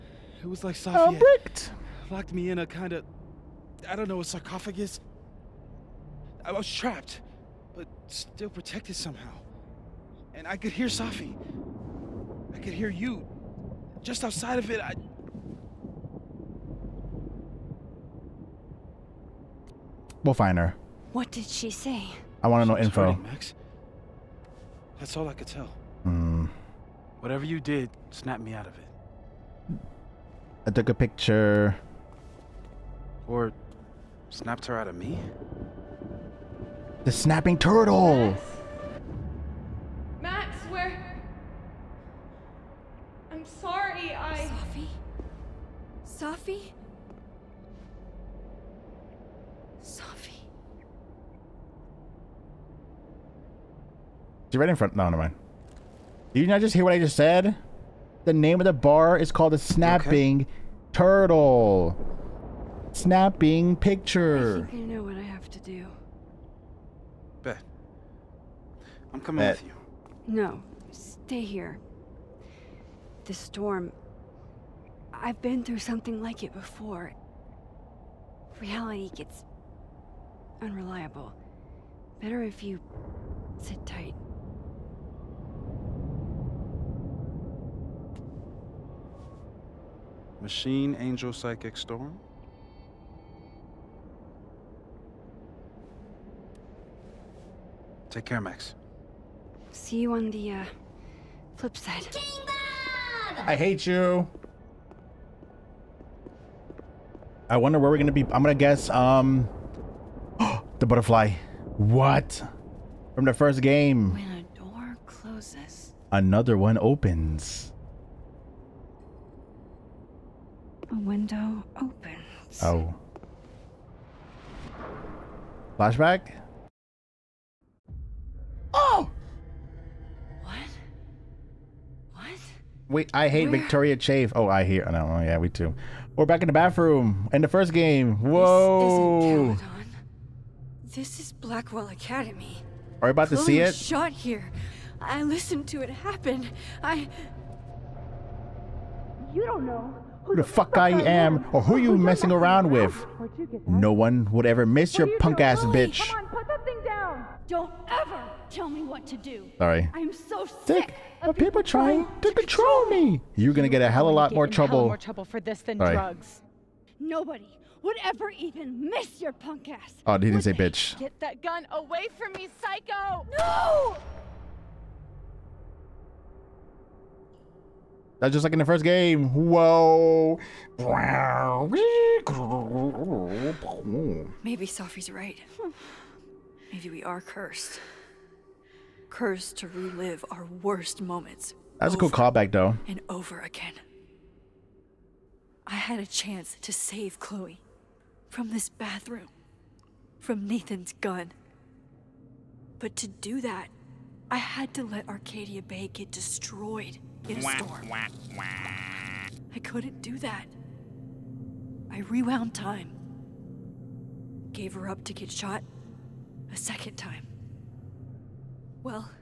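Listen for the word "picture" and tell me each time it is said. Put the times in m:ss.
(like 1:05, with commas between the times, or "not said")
0:30, 1:03.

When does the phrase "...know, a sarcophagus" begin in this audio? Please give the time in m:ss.
0:04.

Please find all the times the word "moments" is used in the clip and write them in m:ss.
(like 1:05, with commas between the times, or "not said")
3:11.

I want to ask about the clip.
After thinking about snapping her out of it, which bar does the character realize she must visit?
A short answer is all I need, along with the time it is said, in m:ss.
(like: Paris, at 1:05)
The Snapping Turtle, at 0:37.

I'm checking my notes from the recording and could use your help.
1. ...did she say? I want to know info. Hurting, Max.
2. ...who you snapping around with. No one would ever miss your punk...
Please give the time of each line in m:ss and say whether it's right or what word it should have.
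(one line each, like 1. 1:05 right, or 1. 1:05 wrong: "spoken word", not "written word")
1. 0:21 right
2. 2:31 wrong: "messing", not "snapping".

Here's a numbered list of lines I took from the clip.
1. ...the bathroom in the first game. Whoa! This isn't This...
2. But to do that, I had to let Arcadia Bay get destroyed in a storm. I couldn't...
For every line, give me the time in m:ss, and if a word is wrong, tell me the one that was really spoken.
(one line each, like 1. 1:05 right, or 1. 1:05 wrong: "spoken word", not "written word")
1. 2:16 right
2. 3:22 right.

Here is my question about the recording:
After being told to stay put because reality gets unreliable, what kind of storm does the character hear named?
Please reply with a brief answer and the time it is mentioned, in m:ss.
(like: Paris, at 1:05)
Machine Angel Psychic Storm, at 1:30.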